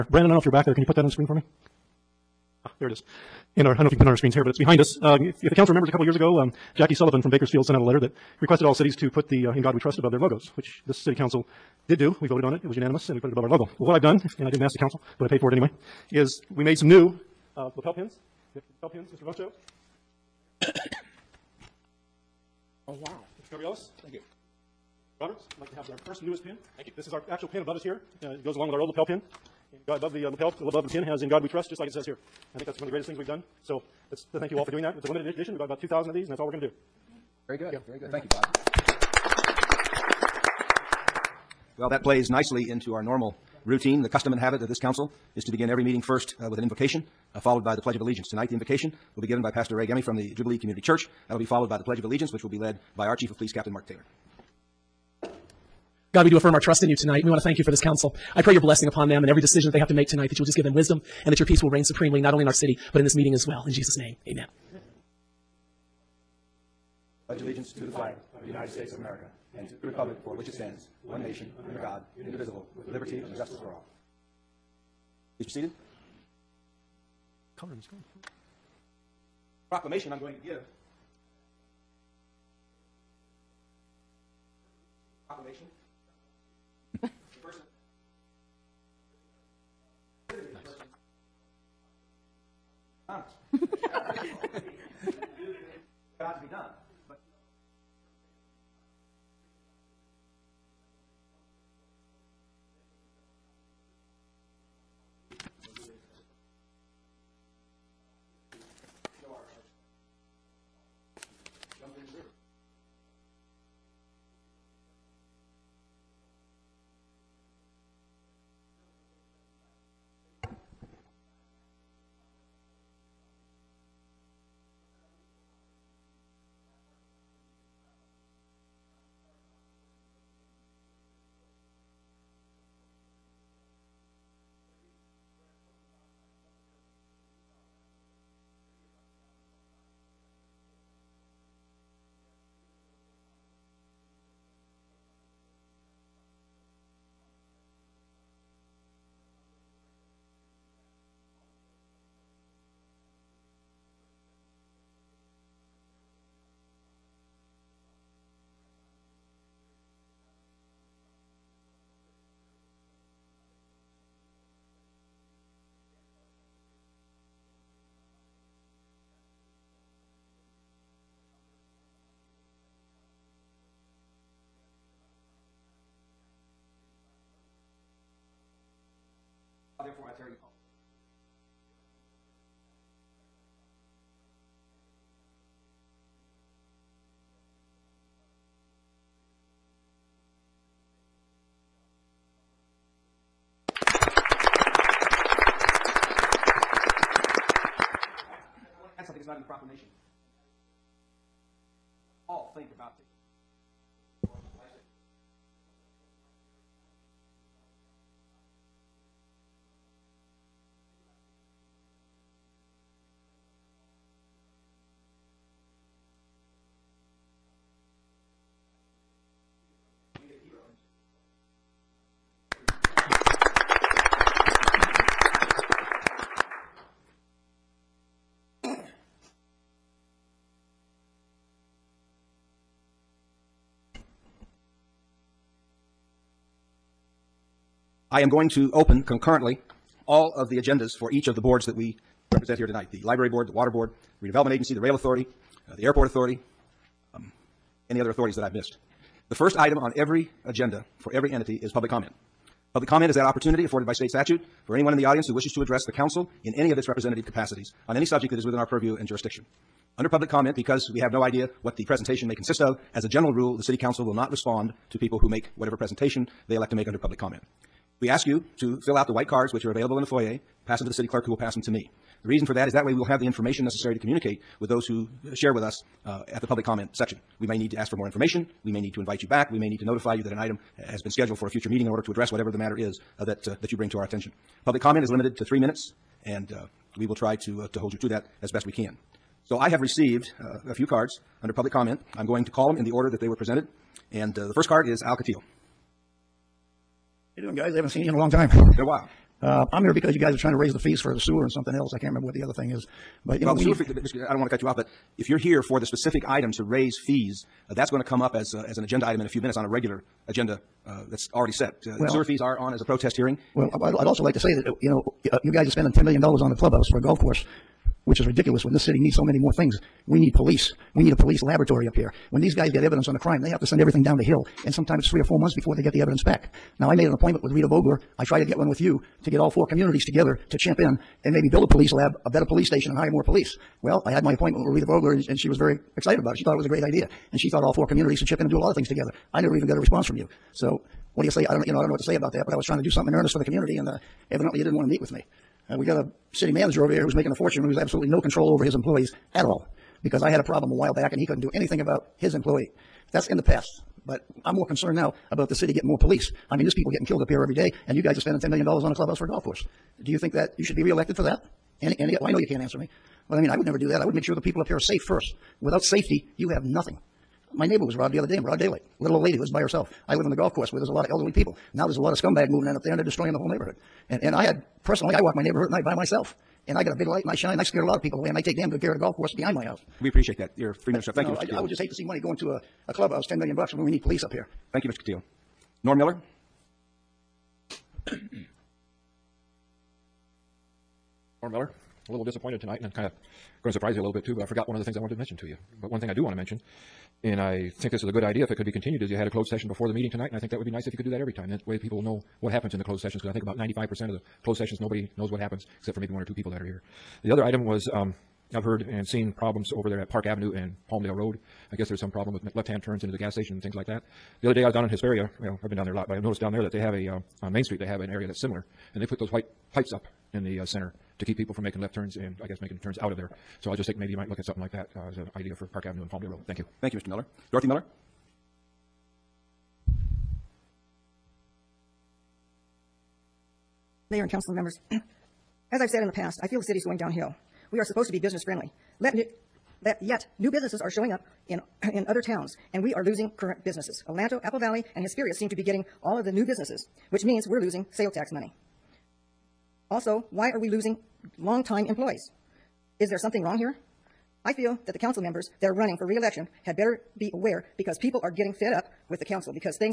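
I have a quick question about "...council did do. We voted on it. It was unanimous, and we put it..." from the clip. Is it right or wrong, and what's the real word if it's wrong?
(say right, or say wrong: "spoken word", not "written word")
right.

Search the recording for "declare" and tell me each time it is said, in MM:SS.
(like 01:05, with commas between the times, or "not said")
not said.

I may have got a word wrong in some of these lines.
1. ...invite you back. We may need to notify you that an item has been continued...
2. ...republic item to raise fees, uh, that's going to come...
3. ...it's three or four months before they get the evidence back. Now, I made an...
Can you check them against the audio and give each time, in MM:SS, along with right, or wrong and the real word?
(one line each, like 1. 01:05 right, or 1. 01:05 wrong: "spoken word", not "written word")
1. 04:38 wrong: "scheduled", not "continued"
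2. 05:05 wrong: "specific", not "republic"
3. 05:25 right.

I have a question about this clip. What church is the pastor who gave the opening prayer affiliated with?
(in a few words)
Jubilee Community Church.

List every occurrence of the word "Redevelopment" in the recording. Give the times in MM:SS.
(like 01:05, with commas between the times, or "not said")
04:04.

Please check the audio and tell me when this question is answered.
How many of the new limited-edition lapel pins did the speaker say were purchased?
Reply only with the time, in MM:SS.
00:35.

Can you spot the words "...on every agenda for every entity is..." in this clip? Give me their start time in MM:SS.
04:09.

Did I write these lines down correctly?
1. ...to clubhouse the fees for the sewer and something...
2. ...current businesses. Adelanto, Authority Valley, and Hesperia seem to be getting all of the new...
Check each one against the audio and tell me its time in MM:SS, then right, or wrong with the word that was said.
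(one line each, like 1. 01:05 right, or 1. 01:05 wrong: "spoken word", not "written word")
1. 05:00 wrong: "raise", not "clubhouse"
2. 07:23 wrong: "Apple", not "Authority".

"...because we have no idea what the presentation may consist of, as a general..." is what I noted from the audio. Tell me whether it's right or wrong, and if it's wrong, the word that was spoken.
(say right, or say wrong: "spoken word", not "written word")
right.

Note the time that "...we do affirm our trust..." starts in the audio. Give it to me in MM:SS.
00:56.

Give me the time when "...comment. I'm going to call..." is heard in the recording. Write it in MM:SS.
04:51.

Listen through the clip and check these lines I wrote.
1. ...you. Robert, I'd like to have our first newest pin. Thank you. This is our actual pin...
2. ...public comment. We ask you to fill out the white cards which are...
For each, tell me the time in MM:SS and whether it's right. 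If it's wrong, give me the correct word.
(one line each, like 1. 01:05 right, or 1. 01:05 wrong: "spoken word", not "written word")
1. 00:24 right
2. 04:26 right.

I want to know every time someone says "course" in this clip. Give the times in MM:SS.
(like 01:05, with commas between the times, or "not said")
05:17, 05:59, 06:10, 06:19.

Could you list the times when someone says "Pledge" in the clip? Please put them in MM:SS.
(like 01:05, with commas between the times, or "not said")
00:47, 00:51, 01:07.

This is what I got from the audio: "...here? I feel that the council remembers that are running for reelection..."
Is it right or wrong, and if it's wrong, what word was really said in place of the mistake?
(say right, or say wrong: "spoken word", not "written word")
wrong: "members", not "remembers".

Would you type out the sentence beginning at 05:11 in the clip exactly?
Uh, Well- Sewer fees are on as a protest hearing.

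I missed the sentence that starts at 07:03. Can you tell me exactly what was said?
So I just think maybe you might look at something like that uh, as an idea for Park Avenue and Palmdale Road.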